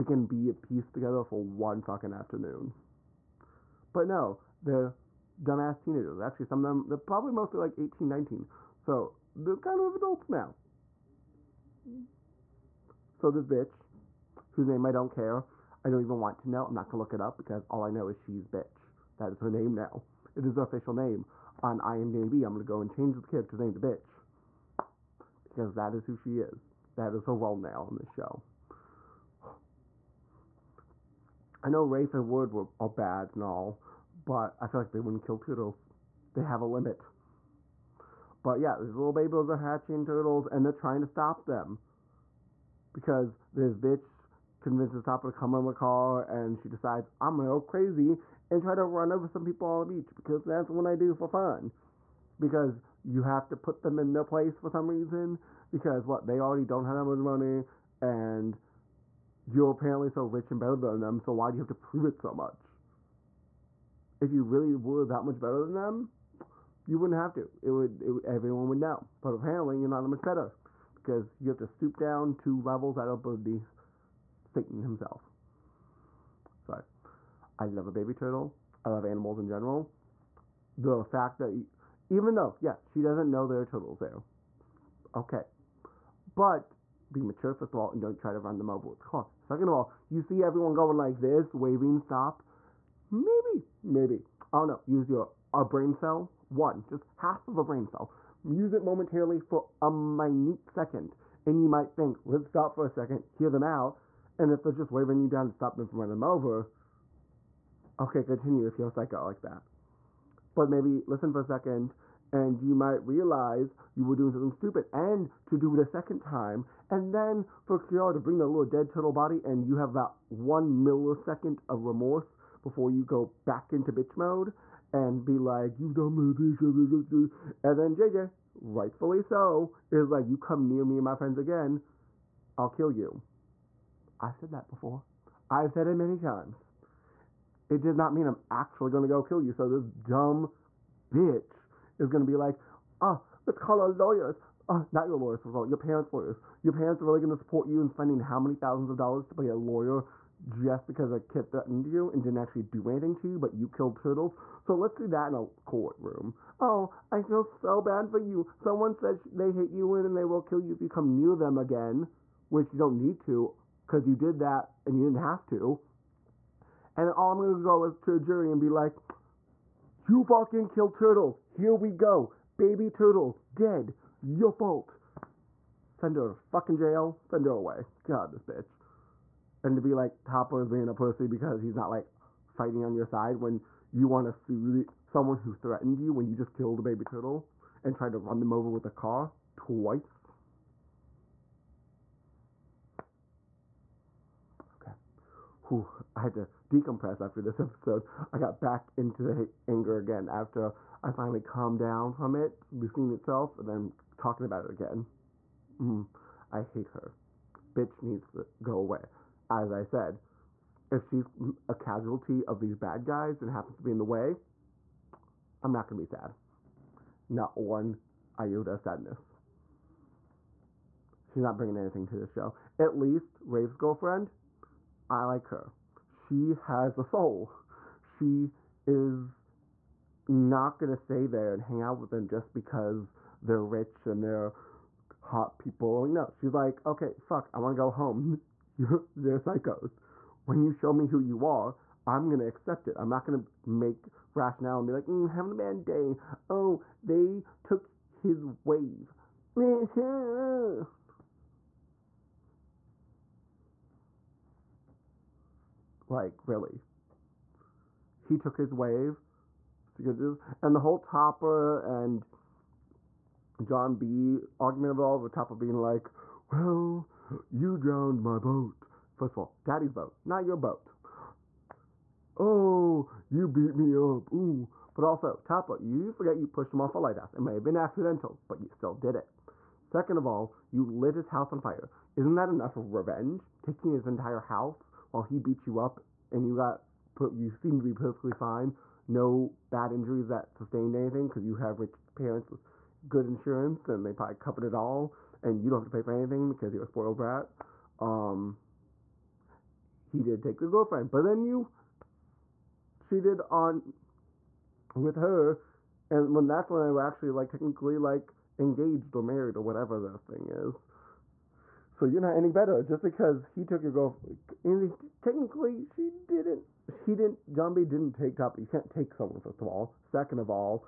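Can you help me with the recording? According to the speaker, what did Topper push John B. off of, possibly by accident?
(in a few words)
a lighthouse.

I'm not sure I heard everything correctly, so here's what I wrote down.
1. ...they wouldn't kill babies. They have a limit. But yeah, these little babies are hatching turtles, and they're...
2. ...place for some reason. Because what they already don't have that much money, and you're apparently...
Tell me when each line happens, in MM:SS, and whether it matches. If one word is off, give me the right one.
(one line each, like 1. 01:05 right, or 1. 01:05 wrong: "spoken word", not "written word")
1. 00:34 wrong: "turtles", not "babies"
2. 00:54 right.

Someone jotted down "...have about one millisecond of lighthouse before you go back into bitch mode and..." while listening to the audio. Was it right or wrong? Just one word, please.
wrong.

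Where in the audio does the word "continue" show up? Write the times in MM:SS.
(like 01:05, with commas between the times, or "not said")
01:48.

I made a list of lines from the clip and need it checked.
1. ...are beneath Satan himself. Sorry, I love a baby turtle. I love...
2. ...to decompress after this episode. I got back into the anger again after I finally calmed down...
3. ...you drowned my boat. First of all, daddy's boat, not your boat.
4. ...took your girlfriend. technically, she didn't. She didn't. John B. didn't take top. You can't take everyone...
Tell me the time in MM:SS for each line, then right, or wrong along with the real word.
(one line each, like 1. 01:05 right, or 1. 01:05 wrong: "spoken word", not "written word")
1. 01:13 right
2. 03:16 right
3. 04:27 right
4. 05:13 wrong: "someone", not "everyone".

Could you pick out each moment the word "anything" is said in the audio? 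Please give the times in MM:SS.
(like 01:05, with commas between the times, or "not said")
02:32, 03:41, 04:50, 04:56.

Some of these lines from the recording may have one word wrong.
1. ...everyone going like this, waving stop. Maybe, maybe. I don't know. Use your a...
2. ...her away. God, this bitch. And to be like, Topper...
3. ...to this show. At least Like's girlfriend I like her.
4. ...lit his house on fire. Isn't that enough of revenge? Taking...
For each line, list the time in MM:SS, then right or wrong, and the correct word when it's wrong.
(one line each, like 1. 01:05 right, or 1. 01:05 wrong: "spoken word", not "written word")
1. 01:30 right
2. 02:57 right
3. 03:42 wrong: "Rafe", not "Like"
4. 04:40 right.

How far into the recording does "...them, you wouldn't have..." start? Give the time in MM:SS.
01:05.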